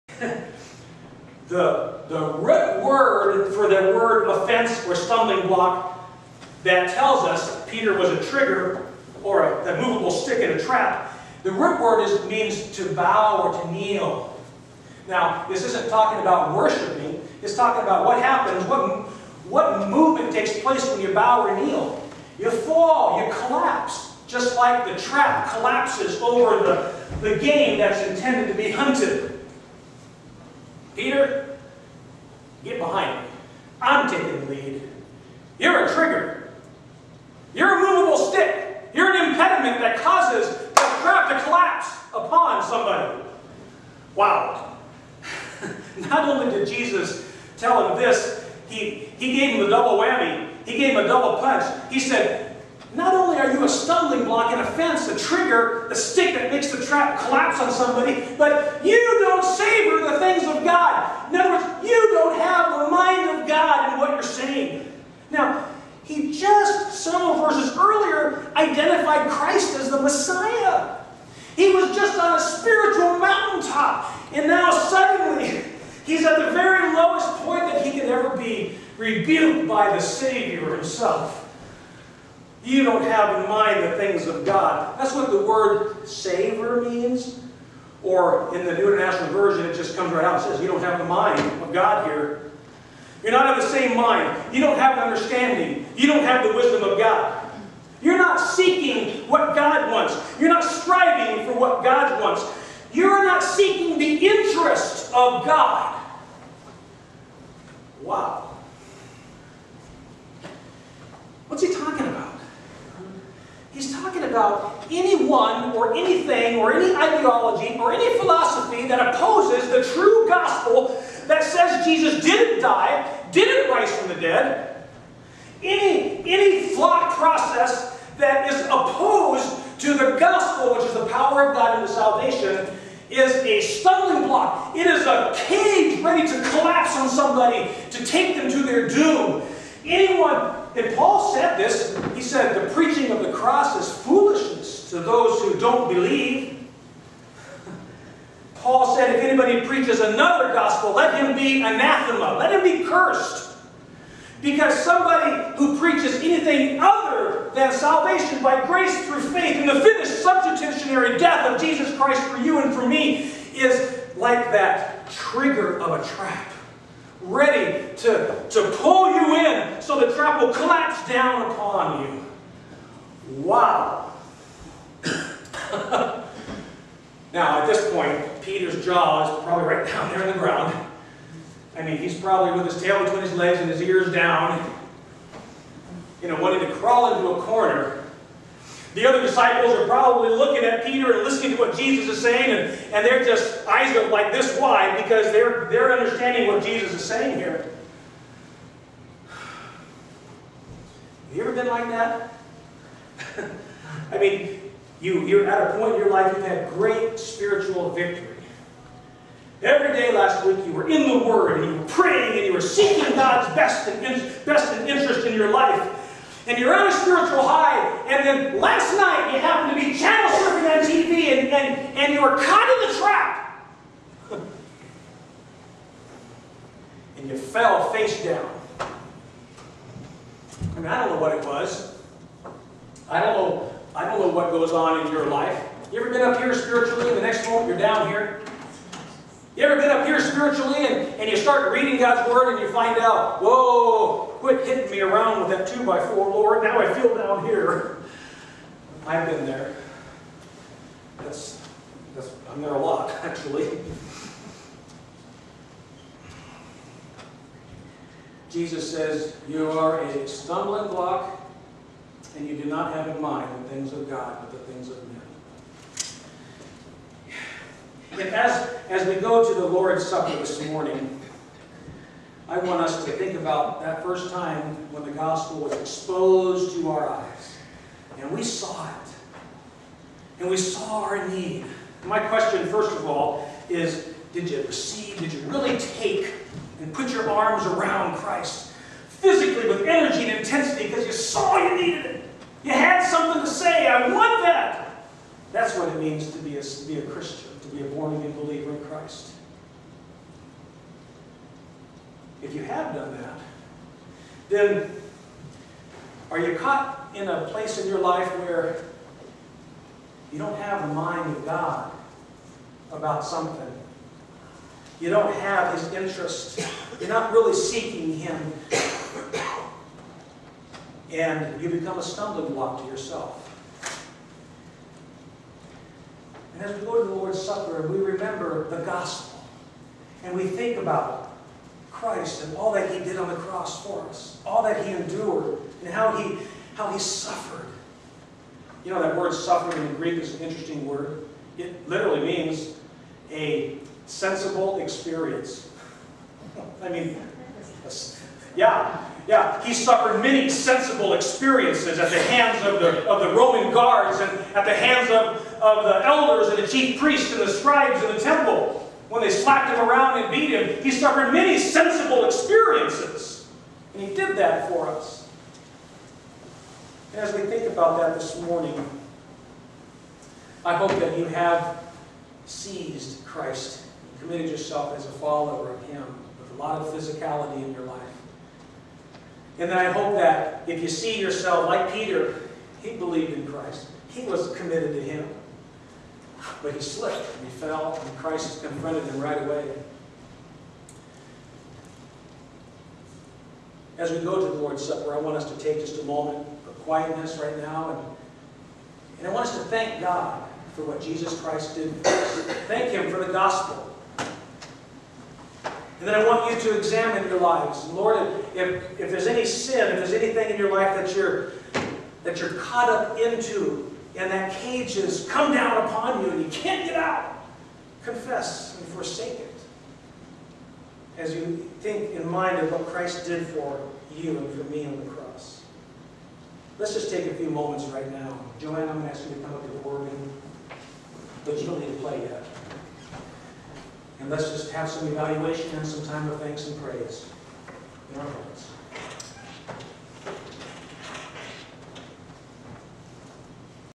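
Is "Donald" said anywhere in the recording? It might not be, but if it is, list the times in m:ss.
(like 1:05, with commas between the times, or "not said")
not said.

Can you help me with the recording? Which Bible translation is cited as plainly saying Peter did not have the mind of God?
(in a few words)
New International Version.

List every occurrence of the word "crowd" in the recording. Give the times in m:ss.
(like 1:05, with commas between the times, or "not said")
0:40.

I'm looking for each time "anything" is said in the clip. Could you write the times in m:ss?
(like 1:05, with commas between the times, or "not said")
1:55, 2:36, 6:50.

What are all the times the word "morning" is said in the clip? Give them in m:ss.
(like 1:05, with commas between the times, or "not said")
4:30, 6:08.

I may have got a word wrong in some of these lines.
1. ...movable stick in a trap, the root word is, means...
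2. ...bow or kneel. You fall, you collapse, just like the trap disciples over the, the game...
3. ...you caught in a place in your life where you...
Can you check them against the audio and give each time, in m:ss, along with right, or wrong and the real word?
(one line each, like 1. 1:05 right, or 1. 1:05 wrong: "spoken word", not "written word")
1. 0:09 right
2. 0:21 wrong: "collapses", not "disciples"
3. 5:06 right.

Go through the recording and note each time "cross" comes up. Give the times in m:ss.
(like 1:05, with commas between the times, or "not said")
2:23, 5:33, 7:05.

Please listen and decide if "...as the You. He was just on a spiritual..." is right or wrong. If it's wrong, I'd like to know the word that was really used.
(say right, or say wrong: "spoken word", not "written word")
wrong: "Messiah", not "You".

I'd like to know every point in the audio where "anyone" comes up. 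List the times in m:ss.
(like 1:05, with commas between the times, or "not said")
1:54, 2:19.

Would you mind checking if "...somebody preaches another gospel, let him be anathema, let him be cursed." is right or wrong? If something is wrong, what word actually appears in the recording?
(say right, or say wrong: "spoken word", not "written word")
wrong: "anybody", not "somebody".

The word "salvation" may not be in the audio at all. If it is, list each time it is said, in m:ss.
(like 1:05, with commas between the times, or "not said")
2:11, 2:37.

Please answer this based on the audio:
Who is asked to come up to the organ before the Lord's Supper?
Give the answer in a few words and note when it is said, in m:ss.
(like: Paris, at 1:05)
Joanne, at 7:08.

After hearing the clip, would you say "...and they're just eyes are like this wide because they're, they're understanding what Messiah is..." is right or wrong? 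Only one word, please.
wrong.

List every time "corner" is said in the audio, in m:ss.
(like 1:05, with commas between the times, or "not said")
3:07.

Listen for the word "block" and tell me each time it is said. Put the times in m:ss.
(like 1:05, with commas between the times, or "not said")
0:05, 0:54, 2:14, 4:20, 5:22.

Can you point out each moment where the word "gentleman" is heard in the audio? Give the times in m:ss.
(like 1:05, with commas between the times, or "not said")
not said.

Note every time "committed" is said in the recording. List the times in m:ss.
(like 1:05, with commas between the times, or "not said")
6:14, 6:24.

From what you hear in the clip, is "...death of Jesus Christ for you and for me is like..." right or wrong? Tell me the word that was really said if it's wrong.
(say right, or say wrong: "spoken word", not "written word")
right.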